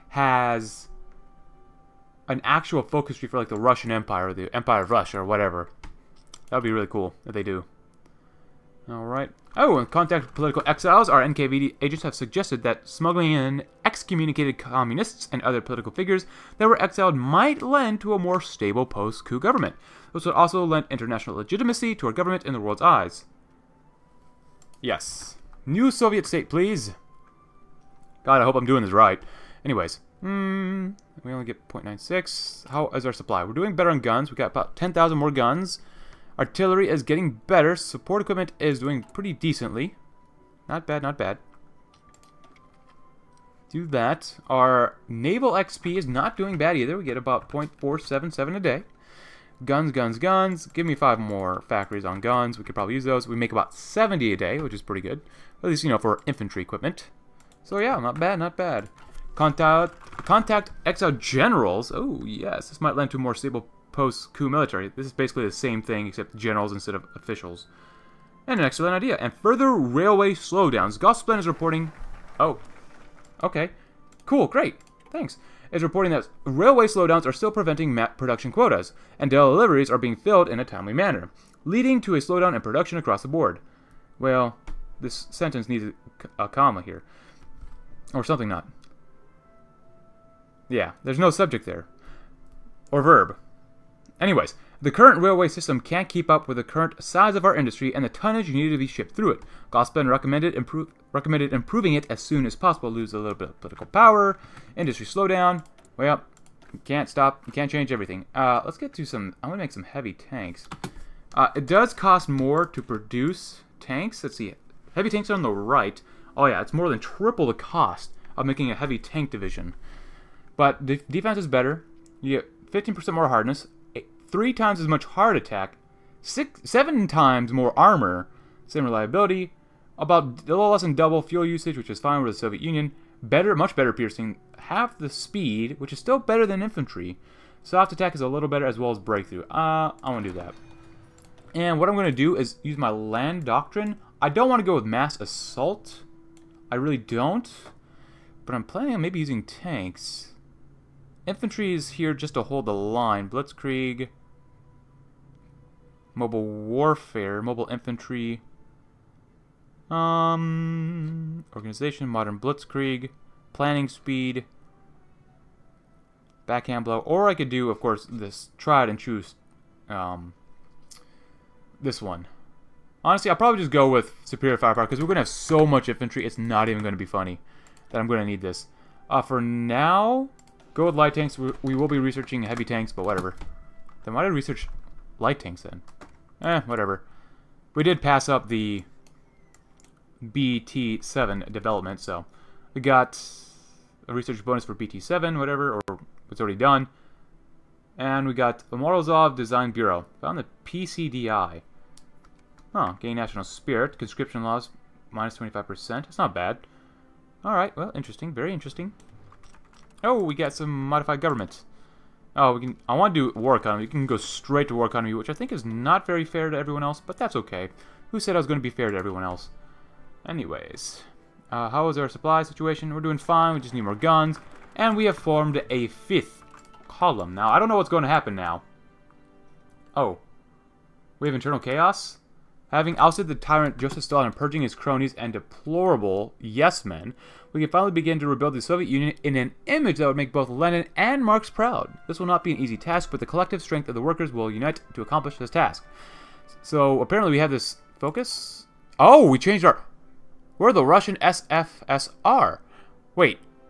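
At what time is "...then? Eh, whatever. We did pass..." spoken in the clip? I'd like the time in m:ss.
3:05.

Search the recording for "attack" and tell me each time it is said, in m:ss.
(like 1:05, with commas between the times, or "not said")
2:05, 2:17.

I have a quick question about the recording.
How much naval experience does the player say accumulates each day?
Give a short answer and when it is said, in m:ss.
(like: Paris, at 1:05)
0.477, at 0:47.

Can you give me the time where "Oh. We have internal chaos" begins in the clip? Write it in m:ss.
3:49.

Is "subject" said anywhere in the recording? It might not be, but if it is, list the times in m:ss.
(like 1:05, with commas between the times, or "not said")
1:31.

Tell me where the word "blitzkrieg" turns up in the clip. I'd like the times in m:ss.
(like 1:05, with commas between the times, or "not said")
2:33, 2:42.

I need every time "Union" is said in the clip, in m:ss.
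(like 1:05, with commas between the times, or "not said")
2:12, 3:58.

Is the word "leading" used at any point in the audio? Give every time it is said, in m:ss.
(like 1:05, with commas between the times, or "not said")
1:21.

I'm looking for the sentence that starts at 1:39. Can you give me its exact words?
Gosplan recommended improve, Recommended improving it as soon as possible.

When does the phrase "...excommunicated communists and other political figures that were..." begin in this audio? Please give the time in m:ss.
0:13.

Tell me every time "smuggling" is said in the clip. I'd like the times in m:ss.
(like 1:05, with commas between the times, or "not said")
0:12.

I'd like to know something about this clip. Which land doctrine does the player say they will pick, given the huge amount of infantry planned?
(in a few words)
Superior firepower.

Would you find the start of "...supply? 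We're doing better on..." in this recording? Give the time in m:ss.
0:33.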